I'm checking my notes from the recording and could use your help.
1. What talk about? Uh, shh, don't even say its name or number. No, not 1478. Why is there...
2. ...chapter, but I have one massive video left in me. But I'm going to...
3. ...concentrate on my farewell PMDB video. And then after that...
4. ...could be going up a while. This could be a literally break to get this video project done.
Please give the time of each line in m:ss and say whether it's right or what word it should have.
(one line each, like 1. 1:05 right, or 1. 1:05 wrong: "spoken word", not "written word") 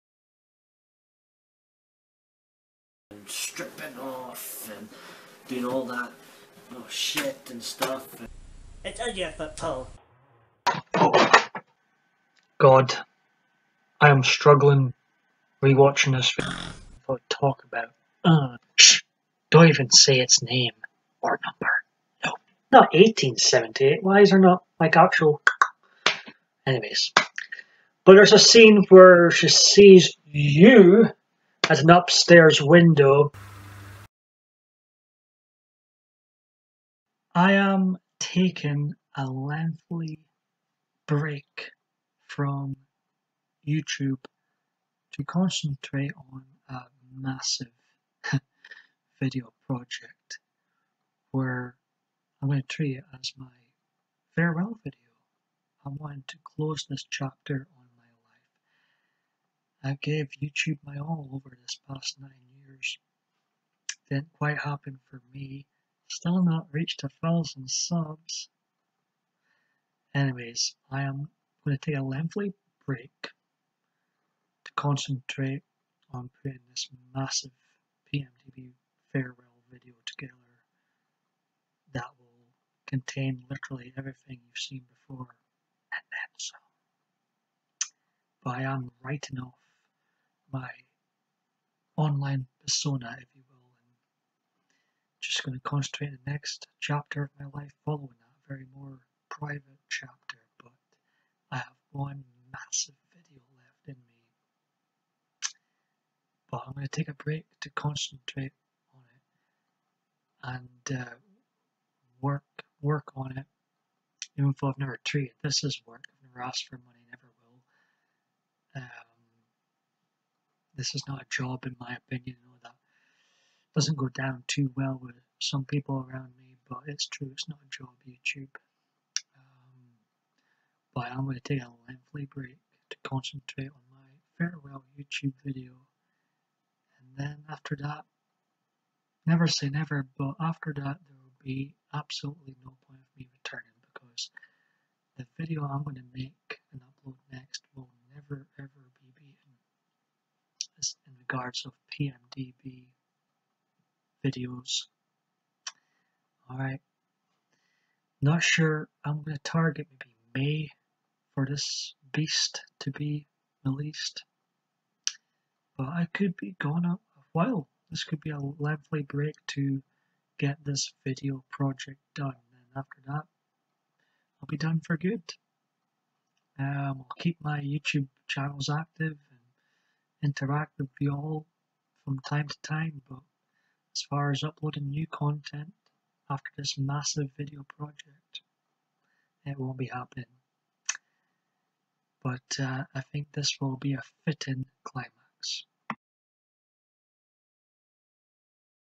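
1. 0:17 wrong: "1878", not "1478"
2. 1:39 right
3. 2:13 wrong: "YouTube", not "PMDB"
4. 2:46 wrong: "lovely", not "literally".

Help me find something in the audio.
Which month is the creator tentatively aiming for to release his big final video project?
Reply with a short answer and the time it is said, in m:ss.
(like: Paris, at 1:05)
May, at 2:40.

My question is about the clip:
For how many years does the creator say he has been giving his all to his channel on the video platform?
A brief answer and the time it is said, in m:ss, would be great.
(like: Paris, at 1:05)
9, at 1:02.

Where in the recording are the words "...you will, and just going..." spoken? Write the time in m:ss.
1:33.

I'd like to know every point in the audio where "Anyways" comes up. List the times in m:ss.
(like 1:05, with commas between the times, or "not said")
0:26, 1:10.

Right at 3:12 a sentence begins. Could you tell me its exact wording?
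But uh, I think this will be a fitting climax.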